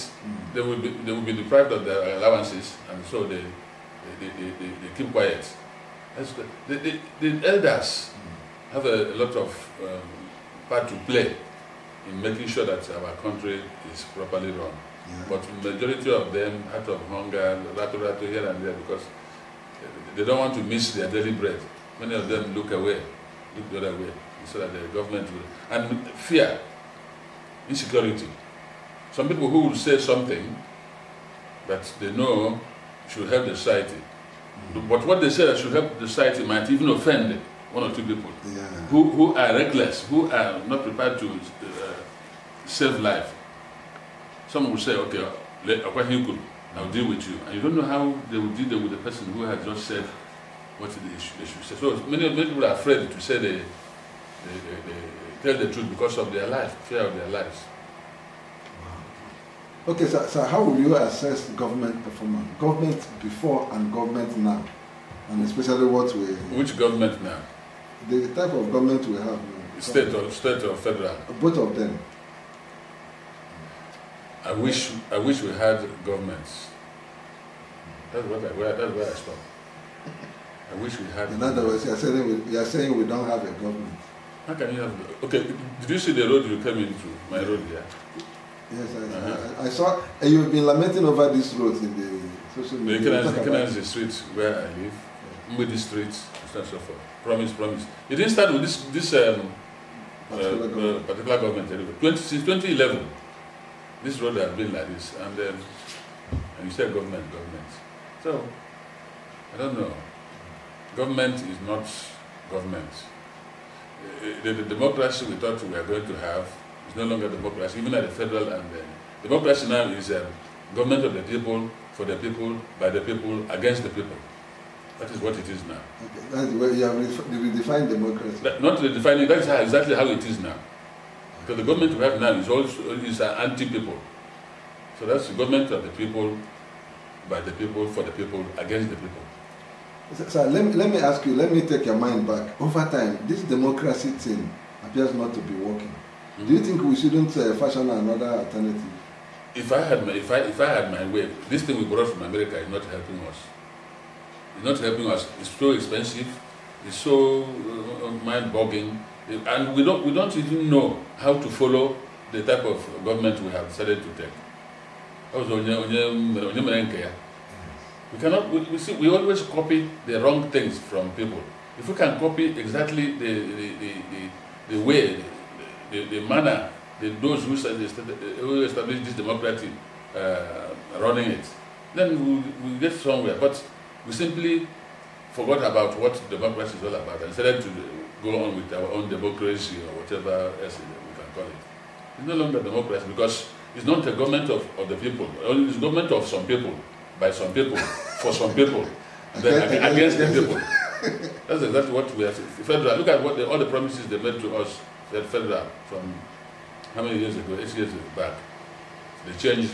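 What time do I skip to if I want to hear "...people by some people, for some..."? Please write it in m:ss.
3:16.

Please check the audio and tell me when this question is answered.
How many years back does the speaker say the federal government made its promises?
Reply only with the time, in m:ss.
3:27.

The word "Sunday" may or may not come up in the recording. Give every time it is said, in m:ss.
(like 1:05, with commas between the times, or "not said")
not said.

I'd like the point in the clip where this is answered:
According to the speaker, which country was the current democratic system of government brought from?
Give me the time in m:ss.
2:32.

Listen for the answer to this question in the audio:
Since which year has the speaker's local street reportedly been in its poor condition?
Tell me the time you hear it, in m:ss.
1:42.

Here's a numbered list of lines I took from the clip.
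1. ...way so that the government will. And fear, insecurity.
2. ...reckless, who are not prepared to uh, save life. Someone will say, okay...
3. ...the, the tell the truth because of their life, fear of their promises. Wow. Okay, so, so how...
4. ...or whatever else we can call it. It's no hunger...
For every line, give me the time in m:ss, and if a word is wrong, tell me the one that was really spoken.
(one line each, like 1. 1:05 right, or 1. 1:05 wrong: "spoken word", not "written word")
1. 0:23 right
2. 0:39 right
3. 0:54 wrong: "lives", not "promises"
4. 3:09 wrong: "longer", not "hunger".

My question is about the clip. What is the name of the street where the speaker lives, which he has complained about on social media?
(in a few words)
Ikenazi.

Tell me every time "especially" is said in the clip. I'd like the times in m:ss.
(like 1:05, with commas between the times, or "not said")
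1:05.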